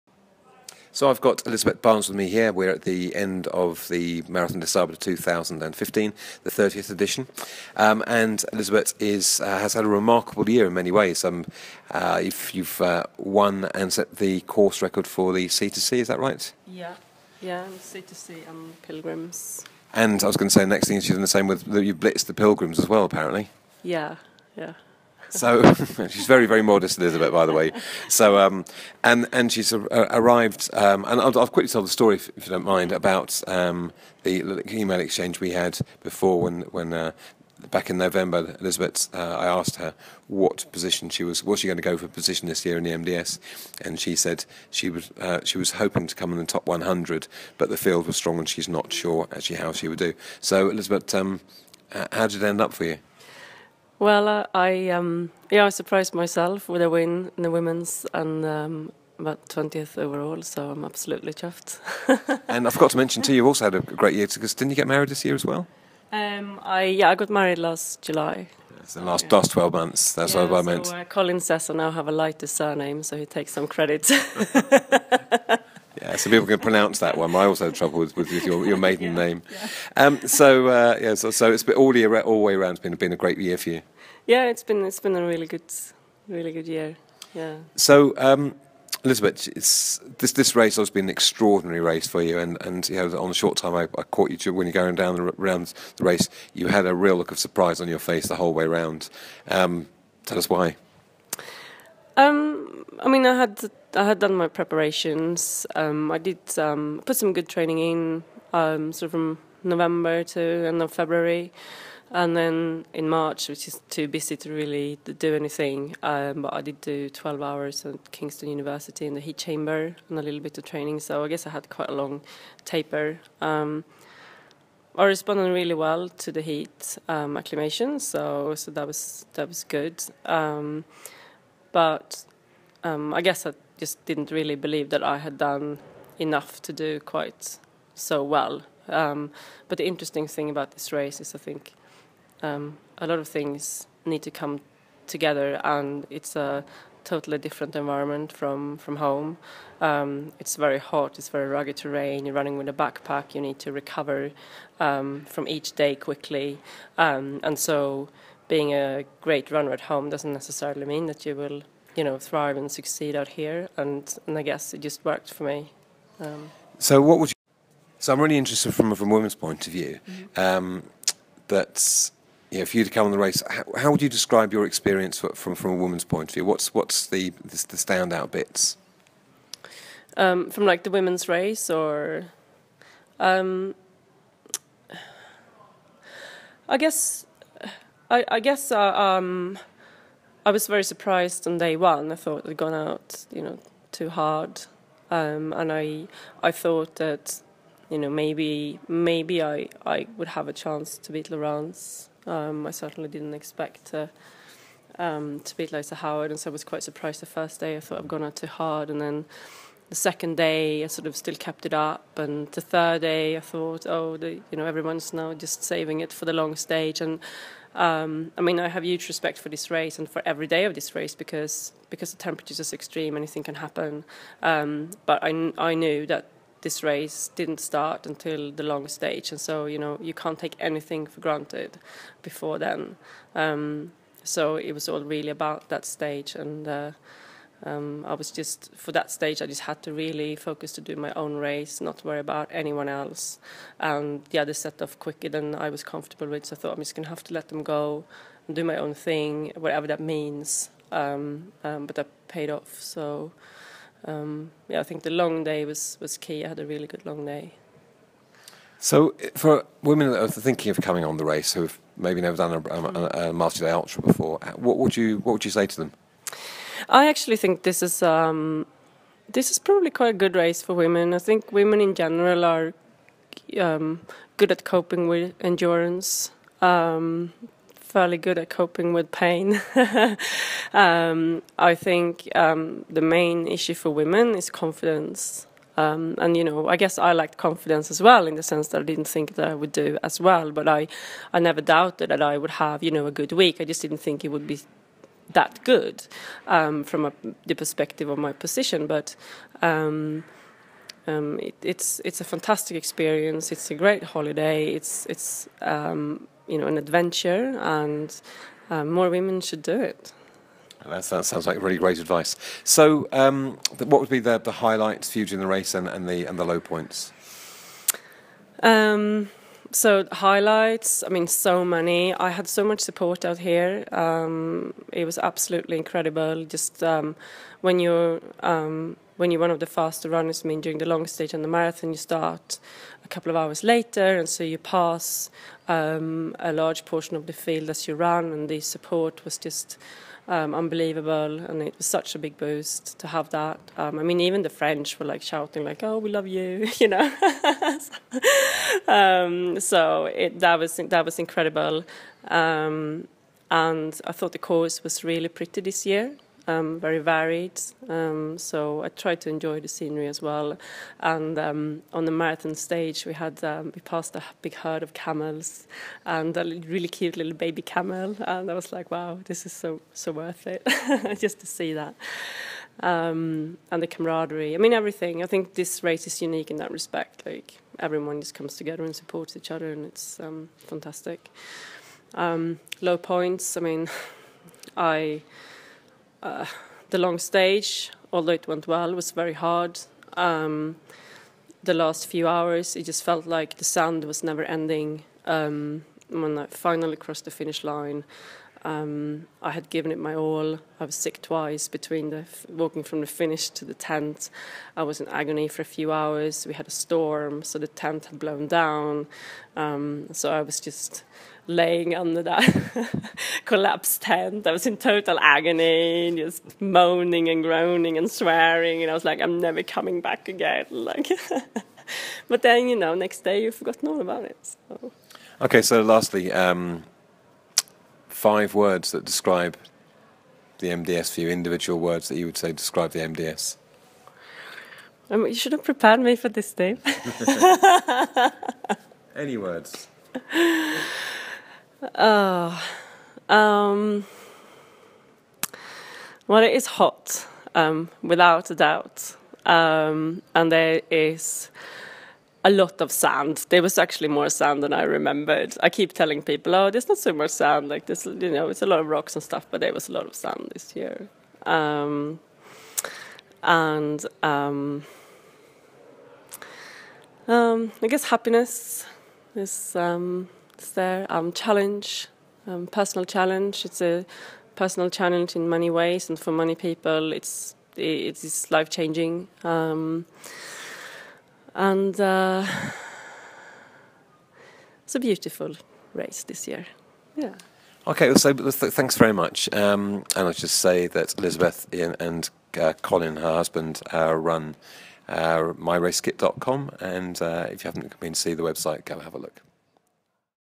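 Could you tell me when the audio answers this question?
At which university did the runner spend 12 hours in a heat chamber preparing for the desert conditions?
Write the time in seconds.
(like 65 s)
118 s.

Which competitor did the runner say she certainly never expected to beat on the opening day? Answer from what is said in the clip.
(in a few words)
Lisa Howard.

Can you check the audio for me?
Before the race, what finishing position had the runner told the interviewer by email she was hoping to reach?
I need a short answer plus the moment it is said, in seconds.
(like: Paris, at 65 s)
Top 100, at 46 s.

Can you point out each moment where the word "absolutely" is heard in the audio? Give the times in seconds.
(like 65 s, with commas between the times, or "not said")
60 s, 325 s.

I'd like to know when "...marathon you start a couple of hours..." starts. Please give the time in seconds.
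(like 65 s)
331 s.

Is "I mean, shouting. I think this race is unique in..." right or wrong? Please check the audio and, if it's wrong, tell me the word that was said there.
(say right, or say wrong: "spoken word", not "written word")
wrong: "everything", not "shouting".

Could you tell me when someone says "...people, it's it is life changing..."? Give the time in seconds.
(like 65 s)
476 s.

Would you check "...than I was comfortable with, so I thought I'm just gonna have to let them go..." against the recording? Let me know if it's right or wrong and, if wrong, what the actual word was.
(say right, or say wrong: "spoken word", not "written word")
right.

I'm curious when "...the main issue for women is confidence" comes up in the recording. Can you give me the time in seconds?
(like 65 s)
282 s.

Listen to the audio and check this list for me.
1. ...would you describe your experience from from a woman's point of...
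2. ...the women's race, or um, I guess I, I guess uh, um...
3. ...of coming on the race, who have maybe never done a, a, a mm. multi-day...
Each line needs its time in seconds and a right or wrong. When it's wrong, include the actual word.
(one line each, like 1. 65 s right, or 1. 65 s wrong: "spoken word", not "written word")
1. 173 s right
2. 180 s right
3. 260 s right.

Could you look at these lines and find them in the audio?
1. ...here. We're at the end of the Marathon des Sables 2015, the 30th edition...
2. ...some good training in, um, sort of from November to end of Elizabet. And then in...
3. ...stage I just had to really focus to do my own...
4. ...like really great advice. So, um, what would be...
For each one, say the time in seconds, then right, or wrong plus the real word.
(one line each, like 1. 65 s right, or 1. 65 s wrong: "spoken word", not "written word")
1. 2 s right
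2. 107 s wrong: "February", not "Elizabet"
3. 239 s right
4. 311 s right.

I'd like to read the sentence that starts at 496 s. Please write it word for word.
And uh, if you haven't been to see the website, go have a look.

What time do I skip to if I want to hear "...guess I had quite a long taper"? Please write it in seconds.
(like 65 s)
121 s.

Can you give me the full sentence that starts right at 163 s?
And, and I guess it just worked for me.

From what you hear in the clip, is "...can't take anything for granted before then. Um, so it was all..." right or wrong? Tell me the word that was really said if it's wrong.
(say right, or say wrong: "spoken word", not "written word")
right.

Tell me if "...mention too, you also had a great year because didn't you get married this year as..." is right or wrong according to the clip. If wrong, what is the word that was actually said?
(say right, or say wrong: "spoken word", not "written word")
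right.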